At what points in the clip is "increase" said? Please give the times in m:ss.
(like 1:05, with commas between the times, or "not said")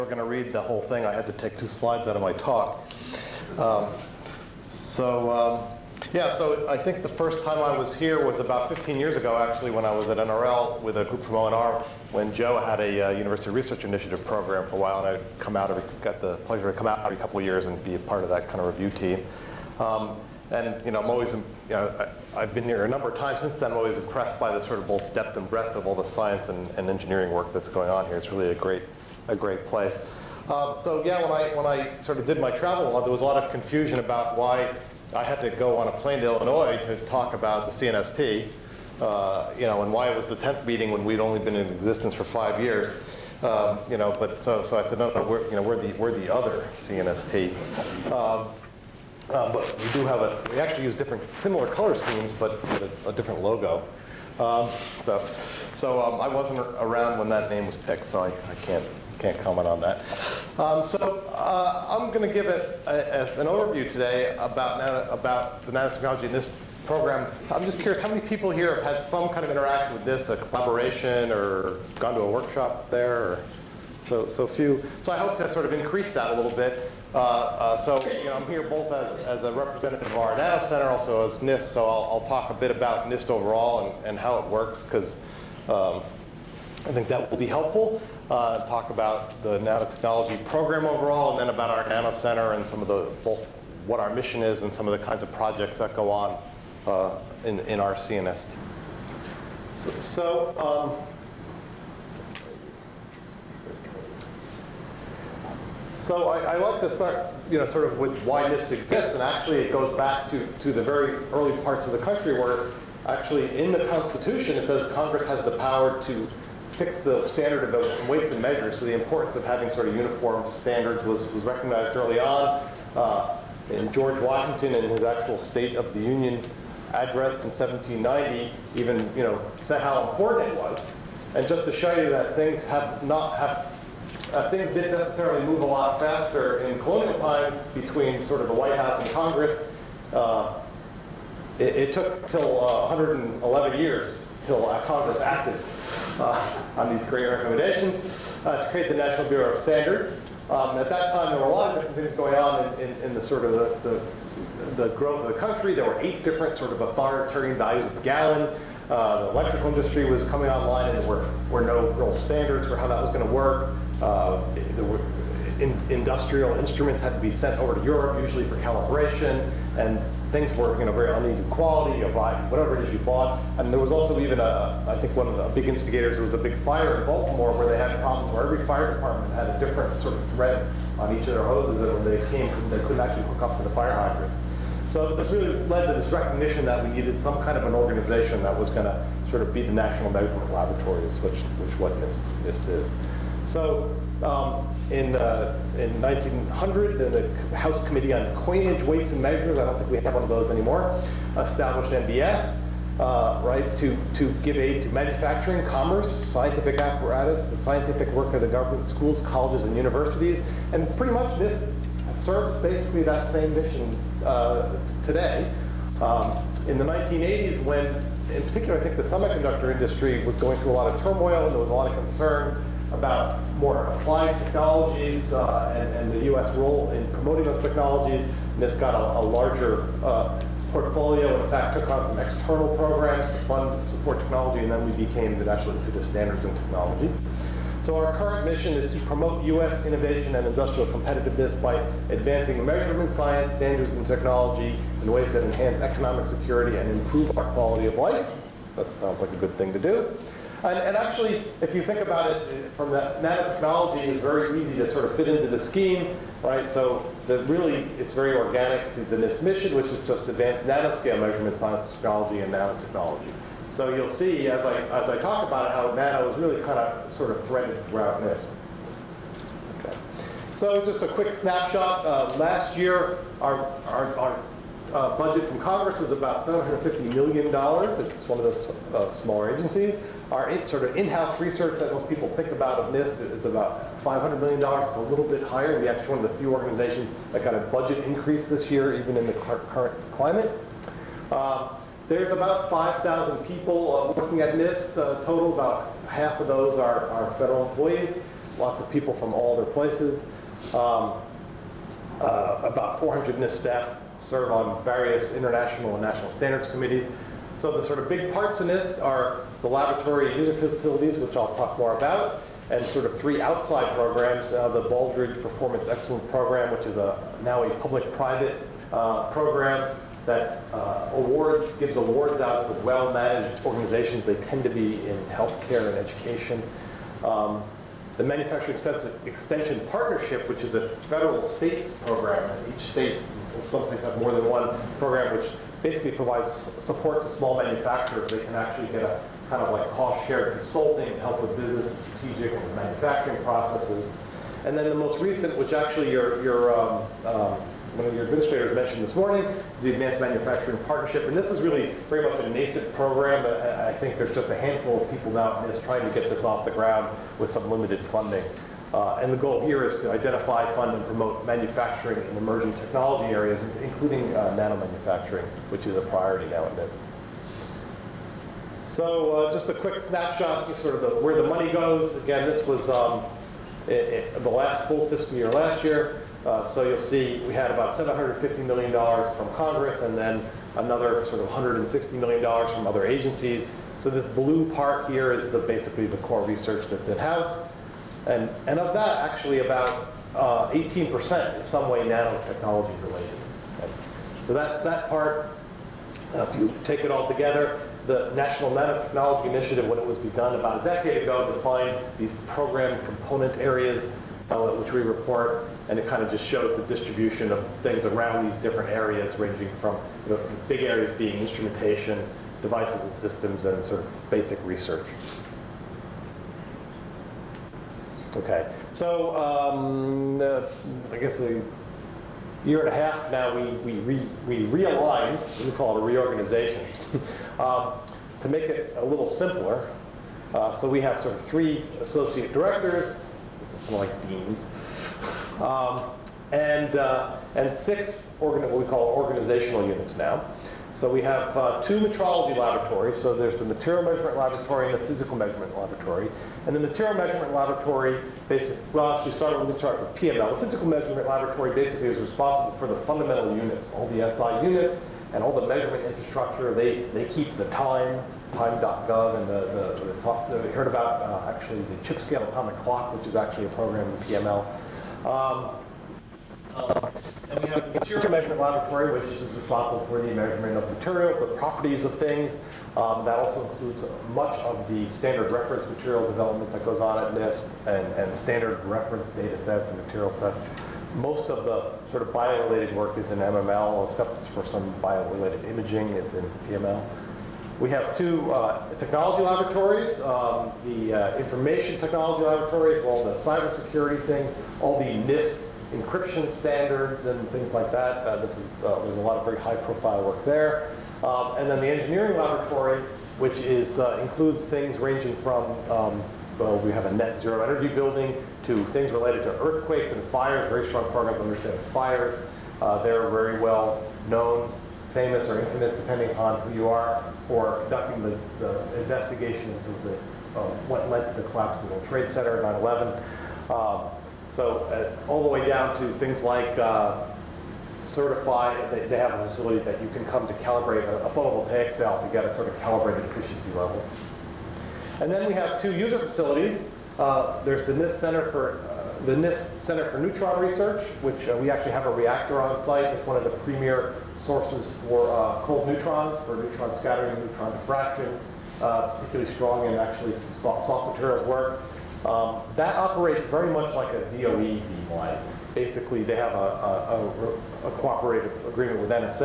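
1:15, 4:48.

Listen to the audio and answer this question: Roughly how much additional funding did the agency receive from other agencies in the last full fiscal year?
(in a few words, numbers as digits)
$160 million.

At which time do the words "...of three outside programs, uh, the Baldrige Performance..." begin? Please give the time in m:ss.
5:13.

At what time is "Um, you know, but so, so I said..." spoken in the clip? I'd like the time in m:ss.
0:43.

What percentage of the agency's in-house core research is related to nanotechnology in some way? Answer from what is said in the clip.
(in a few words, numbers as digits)
18%.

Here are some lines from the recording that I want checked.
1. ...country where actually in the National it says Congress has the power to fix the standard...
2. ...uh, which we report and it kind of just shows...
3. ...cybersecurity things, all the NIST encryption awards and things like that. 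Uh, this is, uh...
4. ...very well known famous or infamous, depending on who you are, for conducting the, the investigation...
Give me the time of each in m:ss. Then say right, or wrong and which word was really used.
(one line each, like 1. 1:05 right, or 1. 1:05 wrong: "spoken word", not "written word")
1. 1:51 wrong: "Constitution", not "National"
2. 6:44 right
3. 8:13 wrong: "standards", not "awards"
4. 8:33 right.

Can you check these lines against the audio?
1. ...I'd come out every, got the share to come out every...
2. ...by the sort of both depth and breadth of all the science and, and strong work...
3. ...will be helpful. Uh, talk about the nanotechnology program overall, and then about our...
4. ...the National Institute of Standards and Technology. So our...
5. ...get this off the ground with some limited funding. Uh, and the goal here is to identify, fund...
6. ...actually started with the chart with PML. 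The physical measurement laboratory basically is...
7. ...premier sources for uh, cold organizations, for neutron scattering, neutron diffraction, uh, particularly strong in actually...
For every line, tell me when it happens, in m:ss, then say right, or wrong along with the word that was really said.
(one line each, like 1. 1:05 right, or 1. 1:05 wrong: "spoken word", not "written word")
1. 0:15 wrong: "pleasure", not "share"
2. 0:24 wrong: "engineering", not "strong"
3. 1:27 right
4. 3:55 right
5. 5:56 right
6. 7:29 right
7. 9:03 wrong: "neutrons", not "organizations".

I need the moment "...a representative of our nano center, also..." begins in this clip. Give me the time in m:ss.
1:19.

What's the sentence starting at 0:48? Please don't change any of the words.
Um, uh, but we do have a, we actually use different, similar color schemes, but a, a different logo.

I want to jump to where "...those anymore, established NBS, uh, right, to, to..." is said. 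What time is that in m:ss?
3:20.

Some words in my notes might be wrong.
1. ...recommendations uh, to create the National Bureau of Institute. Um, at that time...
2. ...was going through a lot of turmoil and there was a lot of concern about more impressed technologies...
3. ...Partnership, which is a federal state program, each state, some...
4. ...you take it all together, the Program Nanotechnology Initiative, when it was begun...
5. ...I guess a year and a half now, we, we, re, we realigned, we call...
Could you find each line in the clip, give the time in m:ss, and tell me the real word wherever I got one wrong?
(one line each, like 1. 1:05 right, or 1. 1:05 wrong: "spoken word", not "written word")
1. 2:27 wrong: "Standards", not "Institute"
2. 3:40 wrong: "applied", not "impressed"
3. 5:29 right
4. 6:36 wrong: "National", not "Program"
5. 7:01 right.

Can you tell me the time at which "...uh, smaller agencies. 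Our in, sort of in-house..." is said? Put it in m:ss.
4:38.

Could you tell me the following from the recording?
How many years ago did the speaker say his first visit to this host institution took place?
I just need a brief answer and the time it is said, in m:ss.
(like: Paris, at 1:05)
15 years, at 0:08.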